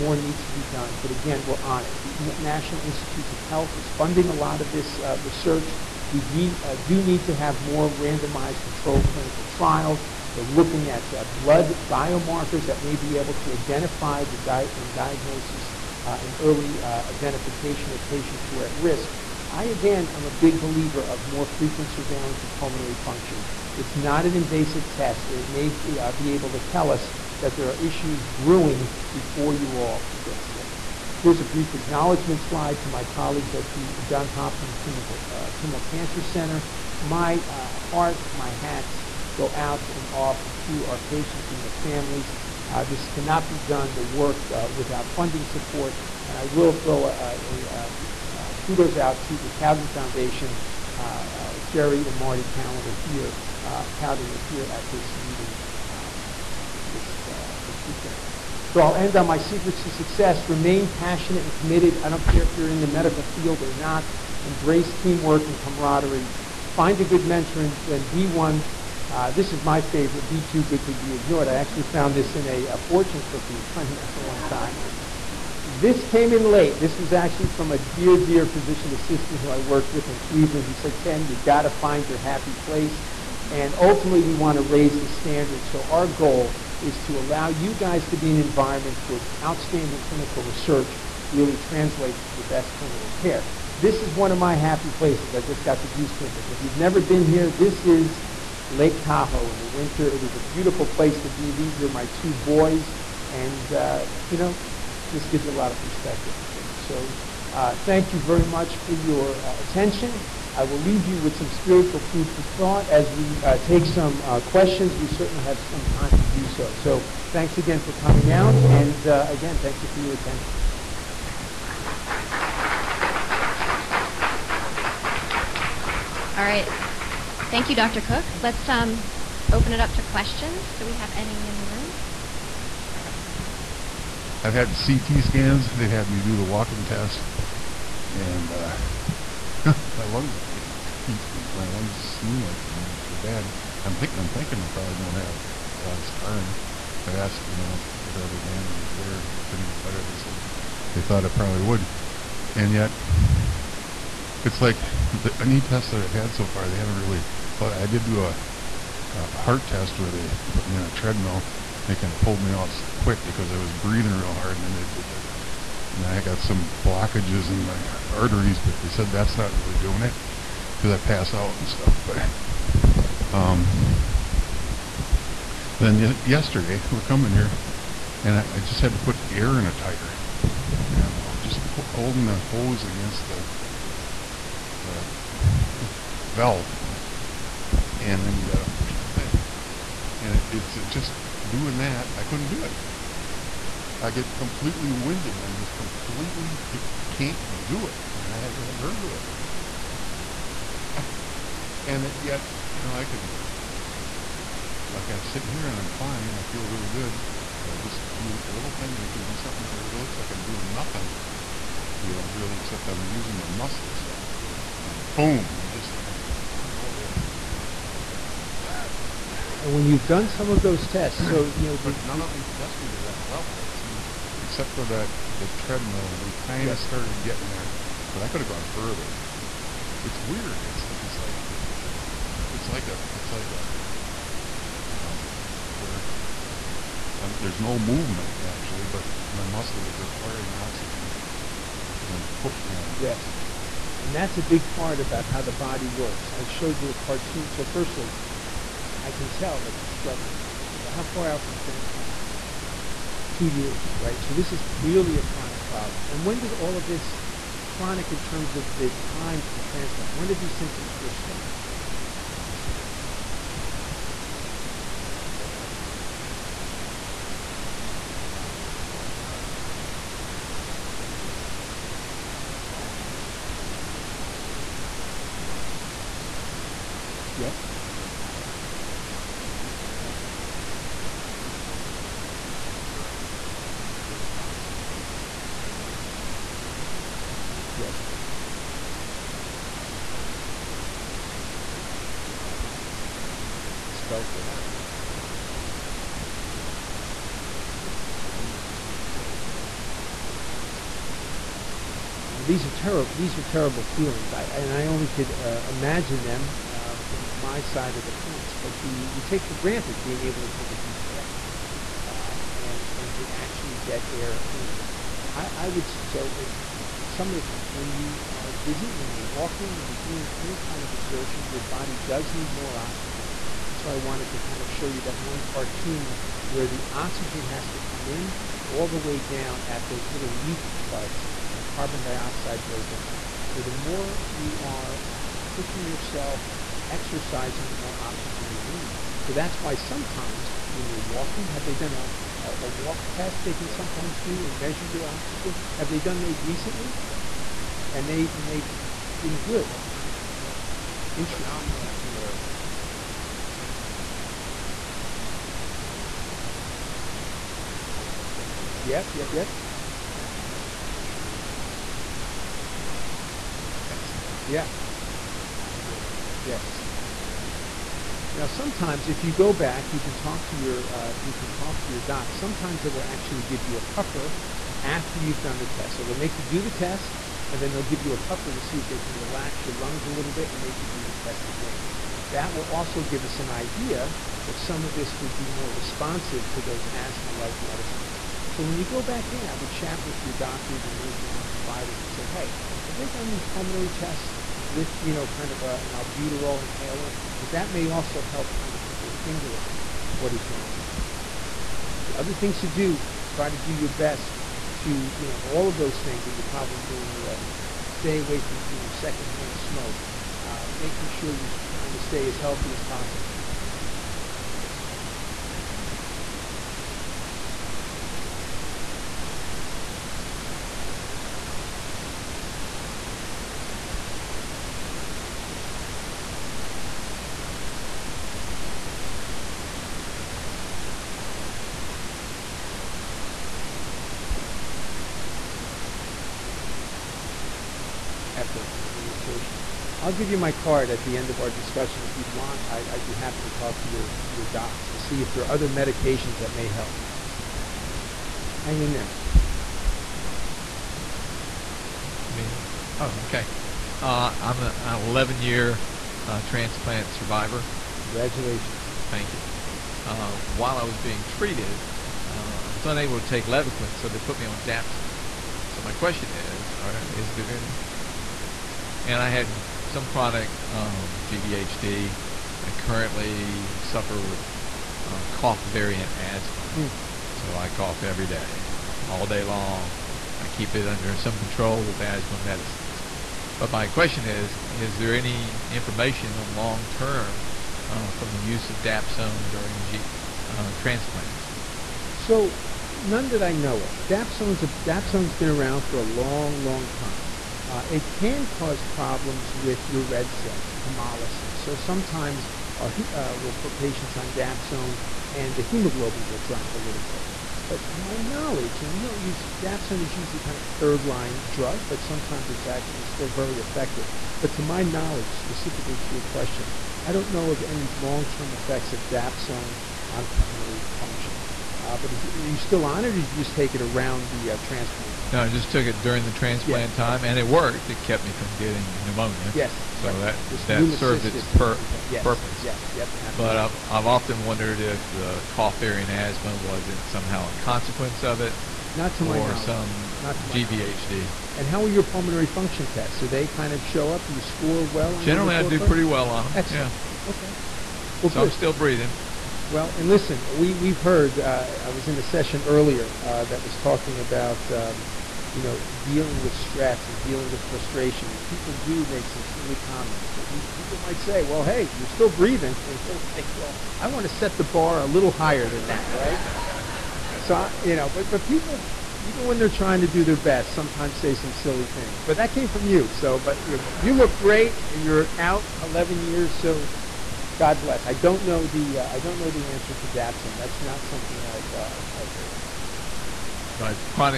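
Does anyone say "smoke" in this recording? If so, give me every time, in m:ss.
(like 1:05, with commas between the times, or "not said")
6:49.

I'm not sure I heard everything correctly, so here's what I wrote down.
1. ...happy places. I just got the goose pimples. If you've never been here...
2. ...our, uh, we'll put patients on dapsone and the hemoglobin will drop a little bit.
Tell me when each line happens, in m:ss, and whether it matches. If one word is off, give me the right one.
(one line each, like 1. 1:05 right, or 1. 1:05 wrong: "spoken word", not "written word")
1. 1:34 right
2. 8:22 right.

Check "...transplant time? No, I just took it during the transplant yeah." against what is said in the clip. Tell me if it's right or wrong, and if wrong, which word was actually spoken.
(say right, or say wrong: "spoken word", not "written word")
right.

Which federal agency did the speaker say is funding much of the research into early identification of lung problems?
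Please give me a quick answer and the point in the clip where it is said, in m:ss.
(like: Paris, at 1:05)
National Institutes of Health, at 0:02.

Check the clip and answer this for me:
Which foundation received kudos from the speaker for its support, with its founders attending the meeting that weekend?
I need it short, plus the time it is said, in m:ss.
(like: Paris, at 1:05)
Cowden Foundation, at 0:49.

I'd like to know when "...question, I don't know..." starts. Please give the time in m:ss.
8:36.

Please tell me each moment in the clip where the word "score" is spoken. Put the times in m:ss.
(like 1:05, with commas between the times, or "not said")
9:04.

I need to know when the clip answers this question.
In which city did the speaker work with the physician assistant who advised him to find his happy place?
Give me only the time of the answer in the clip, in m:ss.
1:20.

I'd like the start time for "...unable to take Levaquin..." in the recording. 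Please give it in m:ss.
7:42.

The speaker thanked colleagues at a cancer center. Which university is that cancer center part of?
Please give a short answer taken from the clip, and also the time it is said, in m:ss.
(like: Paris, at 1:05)
Johns Hopkins, at 0:34.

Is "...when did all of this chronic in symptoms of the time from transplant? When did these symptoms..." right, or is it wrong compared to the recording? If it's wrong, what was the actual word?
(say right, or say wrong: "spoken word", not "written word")
wrong: "terms", not "symptoms".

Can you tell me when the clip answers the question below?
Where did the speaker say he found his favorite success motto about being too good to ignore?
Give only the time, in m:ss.
1:12.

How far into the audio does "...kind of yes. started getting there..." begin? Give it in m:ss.
3:46.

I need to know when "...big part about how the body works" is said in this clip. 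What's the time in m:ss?
4:04.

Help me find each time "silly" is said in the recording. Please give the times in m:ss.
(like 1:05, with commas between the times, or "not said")
9:19, 9:31.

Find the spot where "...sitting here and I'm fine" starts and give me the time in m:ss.
3:25.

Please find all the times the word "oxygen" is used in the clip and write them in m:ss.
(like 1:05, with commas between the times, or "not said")
4:00, 4:44, 5:22, 5:26, 5:37, 5:45, 7:13.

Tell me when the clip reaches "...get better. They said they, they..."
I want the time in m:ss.
2:29.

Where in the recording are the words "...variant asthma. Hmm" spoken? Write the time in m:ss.
7:55.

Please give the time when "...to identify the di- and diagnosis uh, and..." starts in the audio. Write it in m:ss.
0:13.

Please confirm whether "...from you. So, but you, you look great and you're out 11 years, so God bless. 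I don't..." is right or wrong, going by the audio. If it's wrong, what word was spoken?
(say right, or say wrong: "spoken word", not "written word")
right.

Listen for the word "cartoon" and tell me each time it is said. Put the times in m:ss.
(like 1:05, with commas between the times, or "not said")
4:06, 5:25.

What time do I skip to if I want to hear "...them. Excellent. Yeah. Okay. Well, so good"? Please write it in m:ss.
9:06.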